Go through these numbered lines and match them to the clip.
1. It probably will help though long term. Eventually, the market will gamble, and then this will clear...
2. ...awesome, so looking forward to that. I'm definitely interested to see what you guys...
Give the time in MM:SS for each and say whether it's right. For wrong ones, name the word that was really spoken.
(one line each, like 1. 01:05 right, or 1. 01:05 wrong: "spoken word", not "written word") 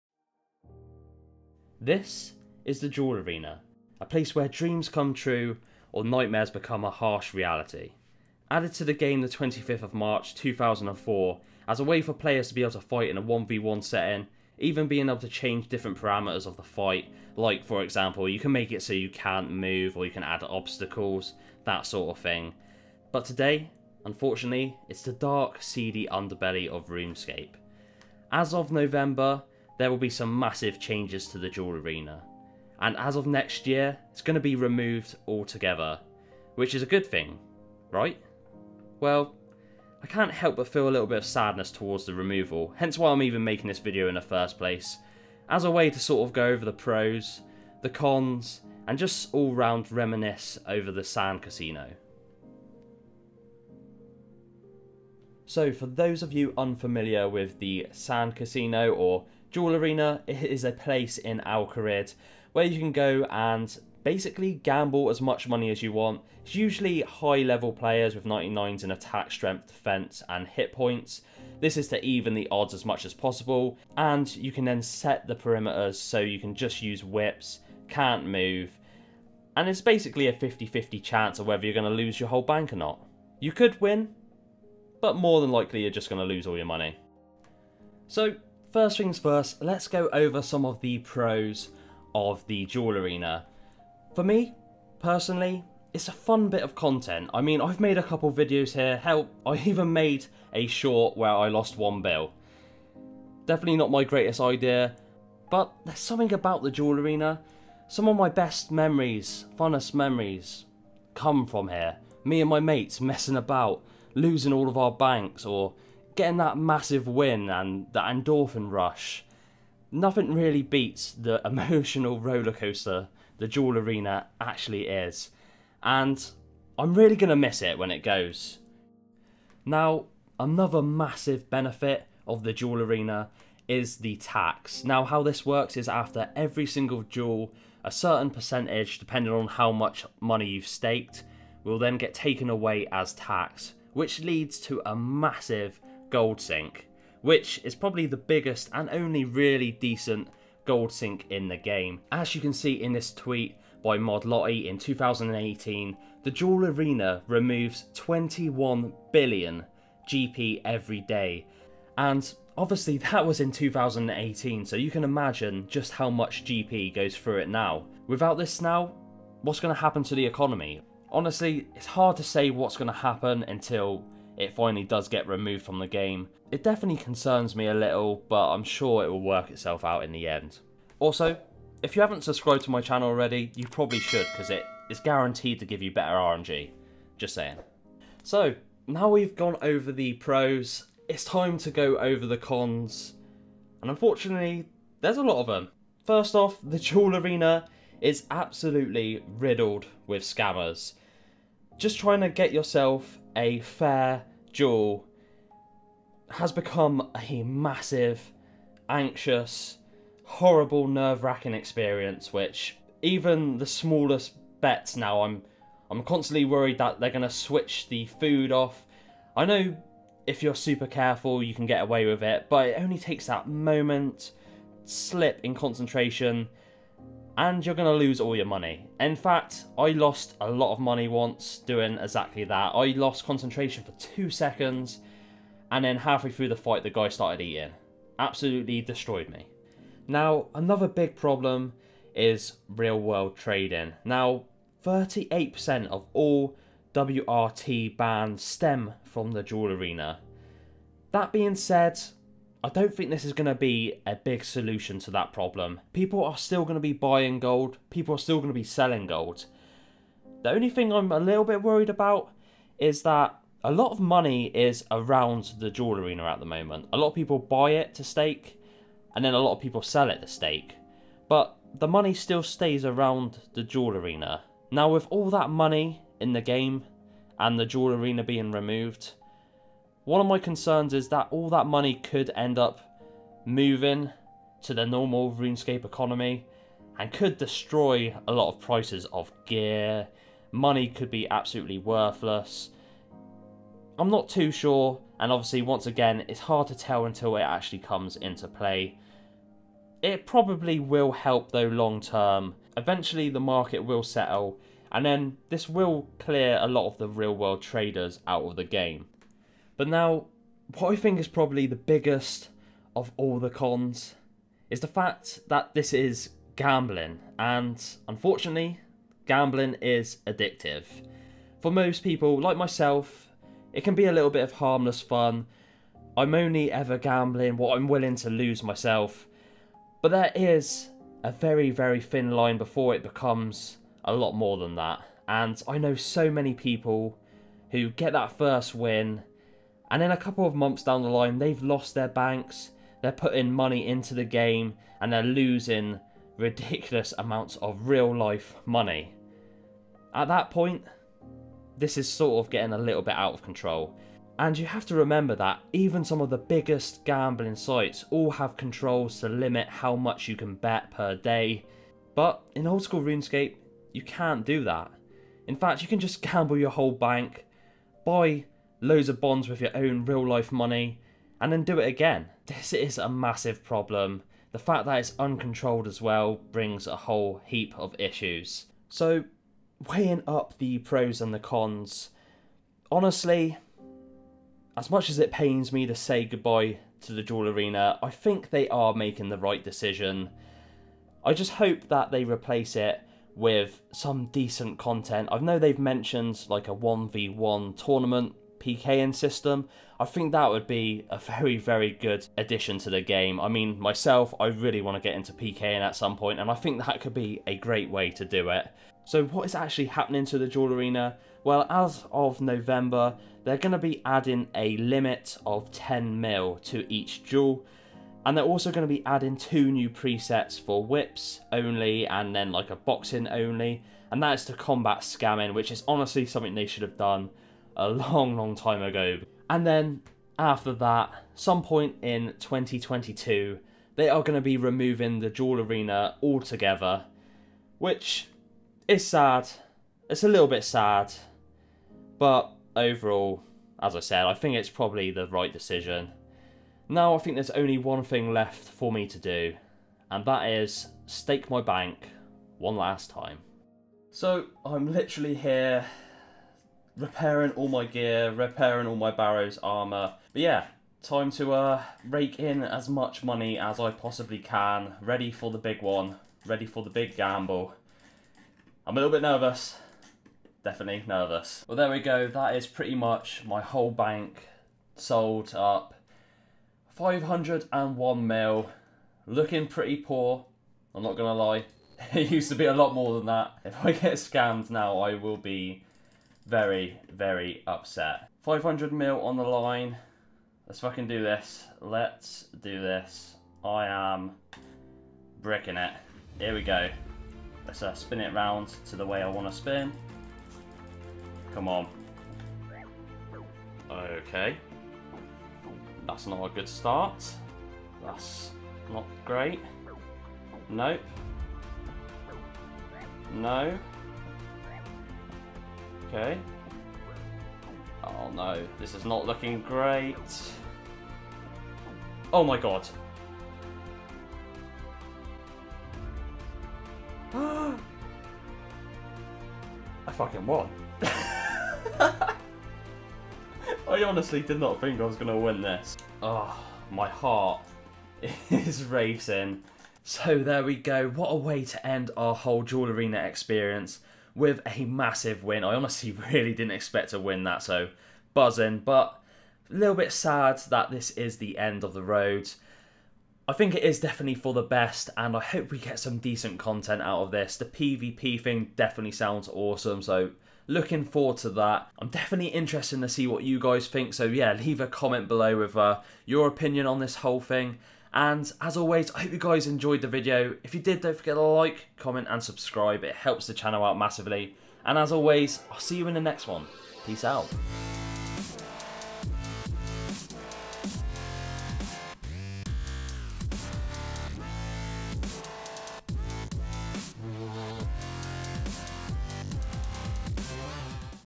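1. 05:00 wrong: "settle", not "gamble"
2. 09:19 right.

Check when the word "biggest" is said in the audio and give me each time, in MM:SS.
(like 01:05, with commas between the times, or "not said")
02:28, 05:11, 05:56.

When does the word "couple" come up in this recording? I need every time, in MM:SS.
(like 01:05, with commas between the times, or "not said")
01:38, 05:40.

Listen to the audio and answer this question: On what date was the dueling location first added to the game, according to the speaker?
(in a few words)
25th of March 2004.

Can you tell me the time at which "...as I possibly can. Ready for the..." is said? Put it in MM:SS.
07:43.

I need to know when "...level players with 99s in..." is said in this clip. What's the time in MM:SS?
01:07.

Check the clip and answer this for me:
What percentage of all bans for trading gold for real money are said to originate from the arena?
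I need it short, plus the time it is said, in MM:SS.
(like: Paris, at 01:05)
38%, at 04:04.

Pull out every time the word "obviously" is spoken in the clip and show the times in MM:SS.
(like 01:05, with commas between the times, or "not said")
02:42, 04:55.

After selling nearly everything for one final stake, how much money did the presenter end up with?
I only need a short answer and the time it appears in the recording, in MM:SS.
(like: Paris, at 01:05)
501 mil, at 07:56.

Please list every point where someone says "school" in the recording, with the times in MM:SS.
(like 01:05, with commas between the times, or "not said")
06:02.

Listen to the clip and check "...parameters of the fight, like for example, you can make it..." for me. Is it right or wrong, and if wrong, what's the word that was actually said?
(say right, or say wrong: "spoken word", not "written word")
right.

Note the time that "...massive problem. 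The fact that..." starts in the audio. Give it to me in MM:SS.
06:13.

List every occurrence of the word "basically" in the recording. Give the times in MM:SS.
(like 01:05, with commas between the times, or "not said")
01:04, 01:19.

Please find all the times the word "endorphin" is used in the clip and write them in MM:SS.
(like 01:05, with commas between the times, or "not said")
01:58.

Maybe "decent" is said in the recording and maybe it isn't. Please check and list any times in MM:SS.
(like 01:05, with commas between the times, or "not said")
02:29, 06:34, 09:16.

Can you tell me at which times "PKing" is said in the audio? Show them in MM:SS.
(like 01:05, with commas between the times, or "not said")
06:38, 06:45.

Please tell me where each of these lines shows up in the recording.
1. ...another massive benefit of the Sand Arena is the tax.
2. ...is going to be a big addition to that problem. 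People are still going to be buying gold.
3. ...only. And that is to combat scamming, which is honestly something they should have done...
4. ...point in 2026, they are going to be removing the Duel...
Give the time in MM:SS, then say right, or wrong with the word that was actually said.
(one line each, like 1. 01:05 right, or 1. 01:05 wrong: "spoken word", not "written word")
1. 02:10 wrong: "Duel", not "Sand"
2. 04:13 wrong: "solution", not "addition"
3. 07:03 right
4. 07:11 wrong: "2022", not "2026".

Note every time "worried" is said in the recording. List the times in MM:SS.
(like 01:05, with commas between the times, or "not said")
03:36, 04:21.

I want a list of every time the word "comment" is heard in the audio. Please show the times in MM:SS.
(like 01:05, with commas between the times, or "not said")
09:24, 09:31.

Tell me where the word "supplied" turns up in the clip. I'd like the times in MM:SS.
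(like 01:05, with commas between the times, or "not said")
not said.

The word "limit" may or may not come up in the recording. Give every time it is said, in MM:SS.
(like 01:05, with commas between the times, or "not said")
05:59, 06:54.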